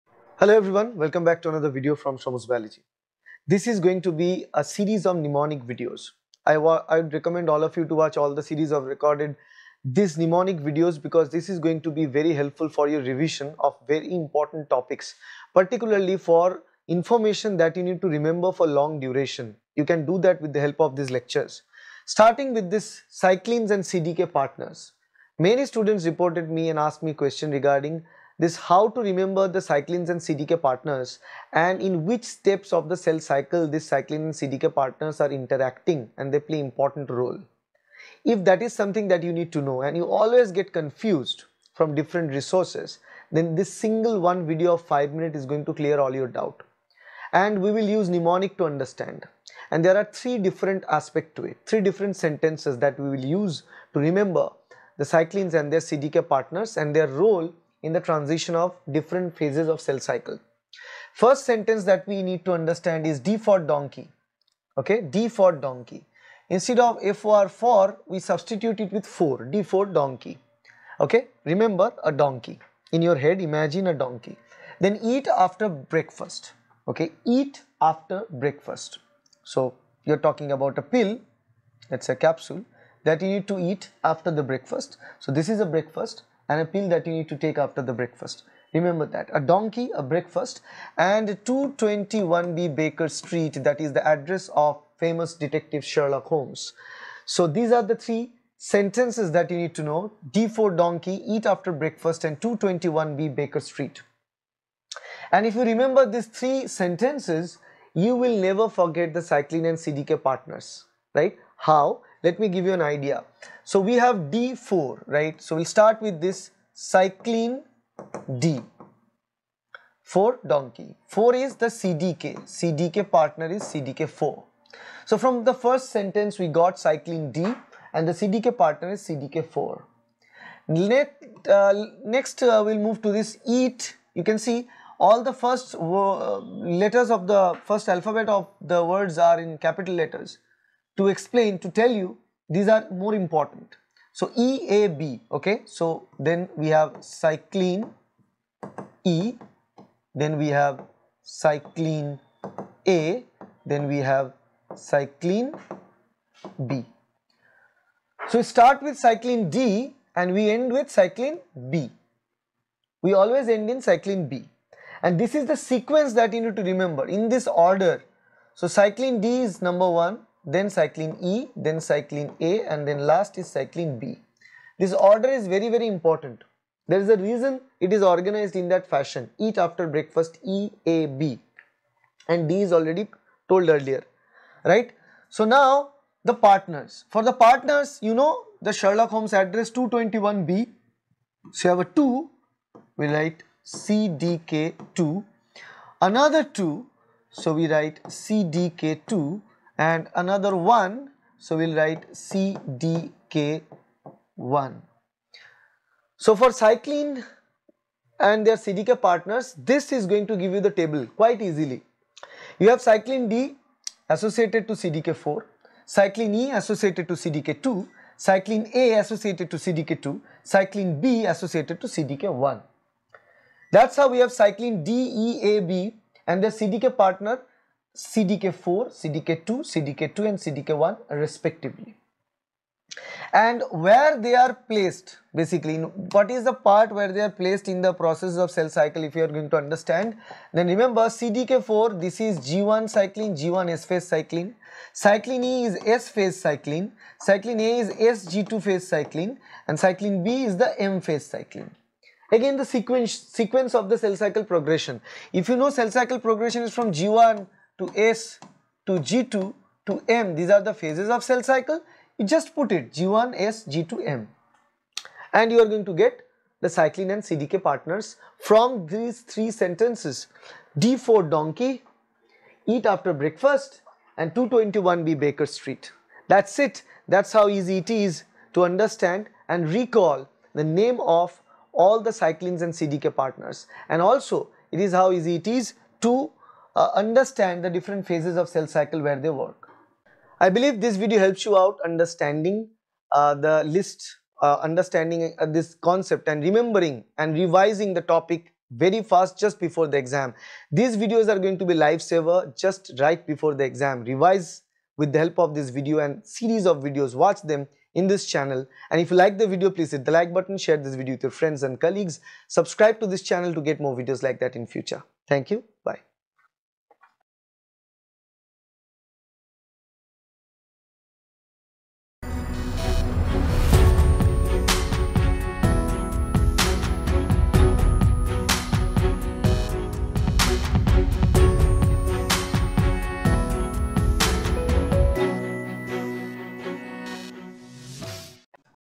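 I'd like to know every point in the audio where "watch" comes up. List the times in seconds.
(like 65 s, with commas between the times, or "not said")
7 s, 307 s.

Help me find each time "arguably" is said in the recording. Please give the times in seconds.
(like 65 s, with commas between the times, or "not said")
not said.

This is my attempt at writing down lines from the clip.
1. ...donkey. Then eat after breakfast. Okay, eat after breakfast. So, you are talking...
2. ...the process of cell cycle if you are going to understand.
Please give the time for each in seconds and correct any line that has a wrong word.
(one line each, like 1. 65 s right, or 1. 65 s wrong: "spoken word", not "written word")
1. 73 s right
2. 237 s right.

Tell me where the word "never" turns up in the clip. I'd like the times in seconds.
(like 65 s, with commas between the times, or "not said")
108 s.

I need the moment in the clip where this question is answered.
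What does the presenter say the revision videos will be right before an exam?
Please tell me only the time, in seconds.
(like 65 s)
301 s.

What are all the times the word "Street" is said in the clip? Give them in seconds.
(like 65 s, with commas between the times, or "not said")
93 s, 103 s, 275 s.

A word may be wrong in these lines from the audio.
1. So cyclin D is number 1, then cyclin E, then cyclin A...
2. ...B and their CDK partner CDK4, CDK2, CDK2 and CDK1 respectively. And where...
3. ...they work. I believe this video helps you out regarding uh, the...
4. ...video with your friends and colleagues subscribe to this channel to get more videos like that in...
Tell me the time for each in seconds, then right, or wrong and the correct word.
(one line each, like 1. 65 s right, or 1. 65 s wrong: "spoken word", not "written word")
1. 168 s right
2. 225 s right
3. 289 s wrong: "understanding", not "regarding"
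4. 310 s right.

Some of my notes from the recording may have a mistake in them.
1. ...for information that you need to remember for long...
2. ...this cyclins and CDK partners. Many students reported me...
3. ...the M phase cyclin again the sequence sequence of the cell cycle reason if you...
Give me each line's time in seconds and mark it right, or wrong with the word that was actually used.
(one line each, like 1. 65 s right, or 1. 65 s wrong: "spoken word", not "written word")
1. 16 s right
2. 22 s right
3. 250 s wrong: "progression", not "reason".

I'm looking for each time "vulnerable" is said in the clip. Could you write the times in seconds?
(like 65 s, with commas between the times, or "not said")
not said.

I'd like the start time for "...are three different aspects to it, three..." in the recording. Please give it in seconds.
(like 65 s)
49 s.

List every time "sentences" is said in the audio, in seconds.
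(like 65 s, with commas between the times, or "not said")
52 s, 61 s, 98 s, 106 s, 125 s, 269 s.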